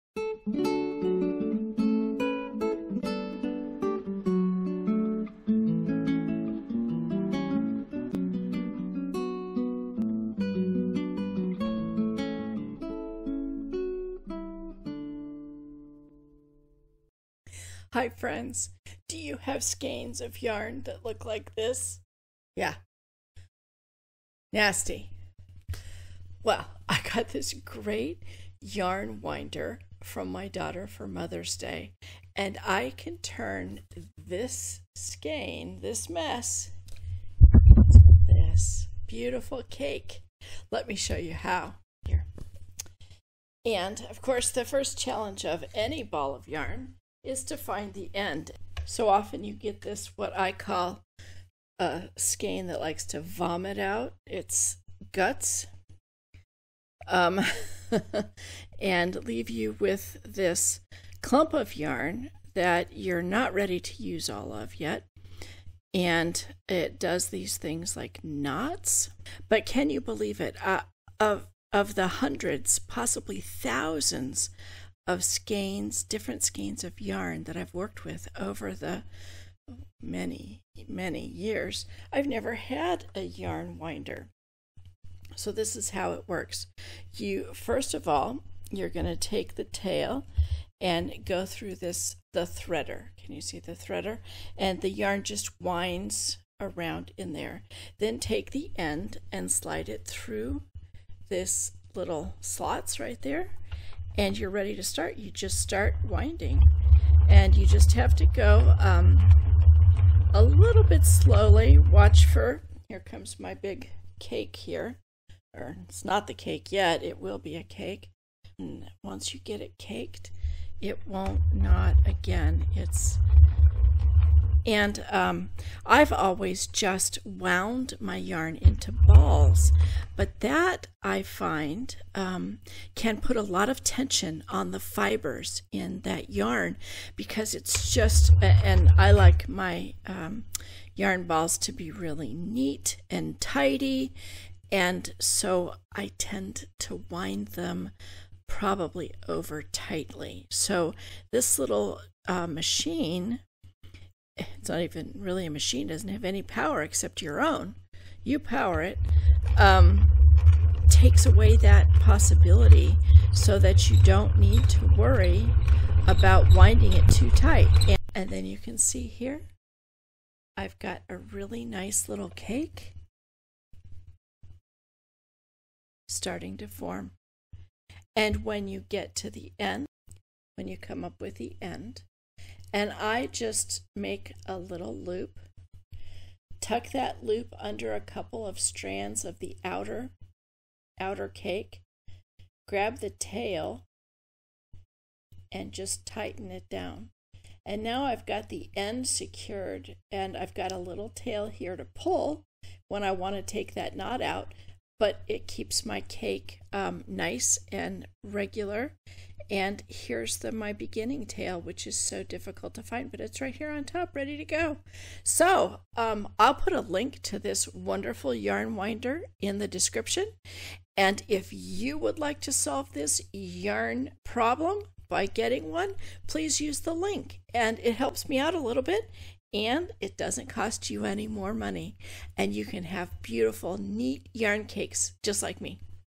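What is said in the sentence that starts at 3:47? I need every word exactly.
And it helps me out a little bit and it doesn't cost you any more money.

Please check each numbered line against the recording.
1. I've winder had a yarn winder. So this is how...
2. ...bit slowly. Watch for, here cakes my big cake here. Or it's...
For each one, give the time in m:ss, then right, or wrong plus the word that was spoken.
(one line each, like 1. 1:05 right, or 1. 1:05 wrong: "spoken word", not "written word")
1. 1:22 wrong: "never", not "winder"
2. 1:50 wrong: "comes", not "cakes".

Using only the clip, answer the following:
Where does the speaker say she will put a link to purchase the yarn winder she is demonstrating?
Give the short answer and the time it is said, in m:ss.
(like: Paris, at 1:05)
In the description, at 3:39.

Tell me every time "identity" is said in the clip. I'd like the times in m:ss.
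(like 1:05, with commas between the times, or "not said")
not said.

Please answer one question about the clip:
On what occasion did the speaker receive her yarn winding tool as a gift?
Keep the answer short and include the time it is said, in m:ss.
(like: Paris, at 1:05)
Mother's Day, at 0:31.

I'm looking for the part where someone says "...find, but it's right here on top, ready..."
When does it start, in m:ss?
3:32.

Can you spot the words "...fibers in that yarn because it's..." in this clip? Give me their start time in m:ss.
2:14.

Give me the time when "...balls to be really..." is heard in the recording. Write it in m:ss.
2:21.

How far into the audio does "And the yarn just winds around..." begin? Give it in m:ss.
1:34.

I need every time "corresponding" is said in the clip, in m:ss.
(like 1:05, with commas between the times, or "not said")
not said.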